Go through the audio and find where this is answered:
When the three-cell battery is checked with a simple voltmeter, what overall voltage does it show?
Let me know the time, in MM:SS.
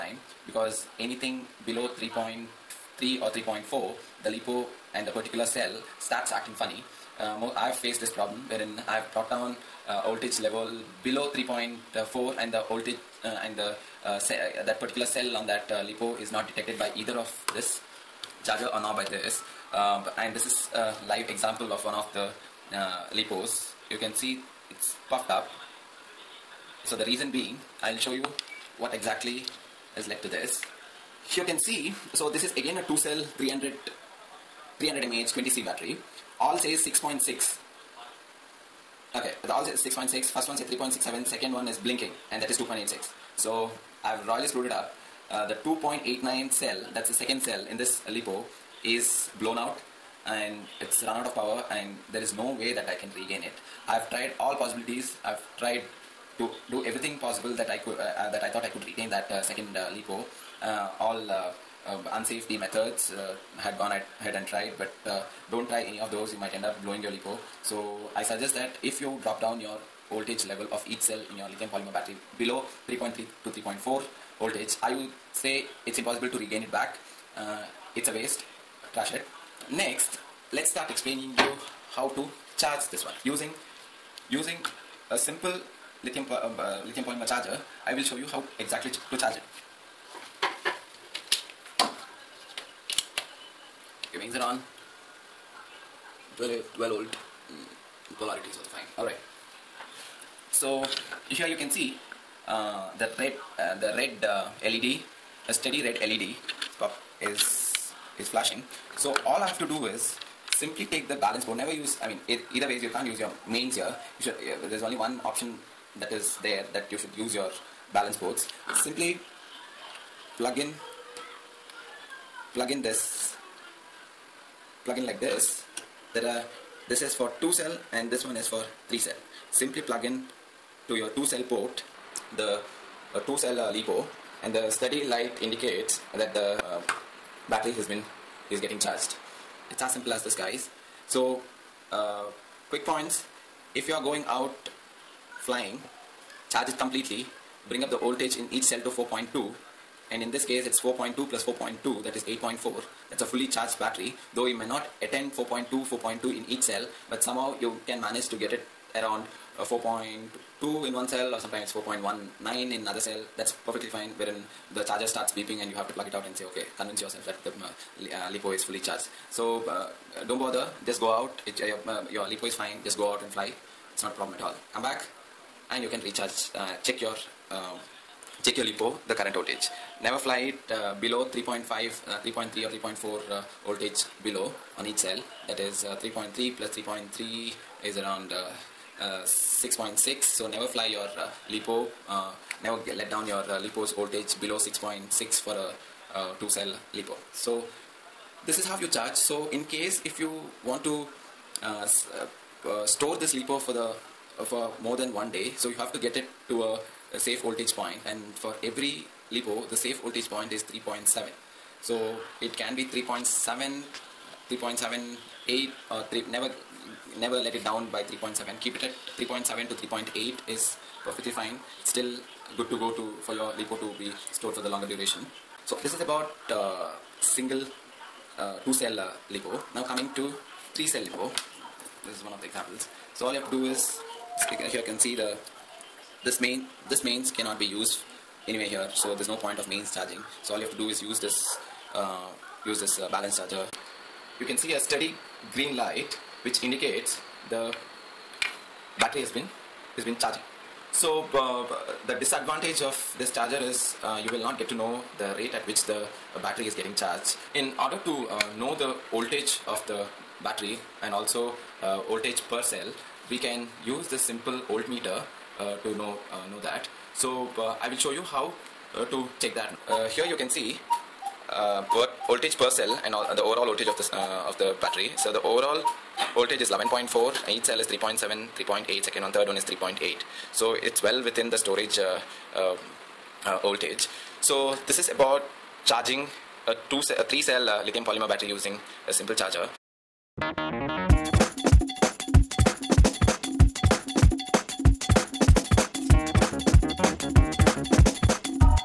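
04:36.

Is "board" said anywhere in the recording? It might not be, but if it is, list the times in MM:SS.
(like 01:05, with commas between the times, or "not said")
01:51, 01:58.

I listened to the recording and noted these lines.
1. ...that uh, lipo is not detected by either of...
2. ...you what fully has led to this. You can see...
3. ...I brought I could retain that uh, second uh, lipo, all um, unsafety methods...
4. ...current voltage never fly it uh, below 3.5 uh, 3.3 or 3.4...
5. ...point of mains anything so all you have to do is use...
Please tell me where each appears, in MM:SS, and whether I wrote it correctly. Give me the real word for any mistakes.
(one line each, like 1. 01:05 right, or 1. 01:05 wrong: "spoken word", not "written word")
1. 00:15 right
2. 00:28 wrong: "exactly", not "fully"
3. 00:58 wrong: "thought", not "brought"
4. 02:59 right
5. 03:59 wrong: "charging", not "anything".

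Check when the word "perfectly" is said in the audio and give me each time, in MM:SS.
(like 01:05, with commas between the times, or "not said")
02:43, 03:41.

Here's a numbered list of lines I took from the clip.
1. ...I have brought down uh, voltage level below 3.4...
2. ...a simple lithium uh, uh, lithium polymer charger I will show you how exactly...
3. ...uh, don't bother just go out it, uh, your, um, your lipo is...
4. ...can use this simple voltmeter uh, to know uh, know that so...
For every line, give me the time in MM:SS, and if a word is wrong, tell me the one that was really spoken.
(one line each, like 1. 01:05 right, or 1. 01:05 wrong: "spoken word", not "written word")
1. 00:08 right
2. 01:25 right
3. 02:49 right
4. 04:23 right.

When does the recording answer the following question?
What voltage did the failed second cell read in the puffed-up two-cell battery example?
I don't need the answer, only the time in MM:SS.
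00:42.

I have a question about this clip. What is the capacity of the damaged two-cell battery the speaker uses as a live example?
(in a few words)
300 mAh.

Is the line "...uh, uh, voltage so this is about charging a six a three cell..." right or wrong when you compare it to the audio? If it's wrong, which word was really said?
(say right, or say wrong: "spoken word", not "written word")
wrong: "two", not "six".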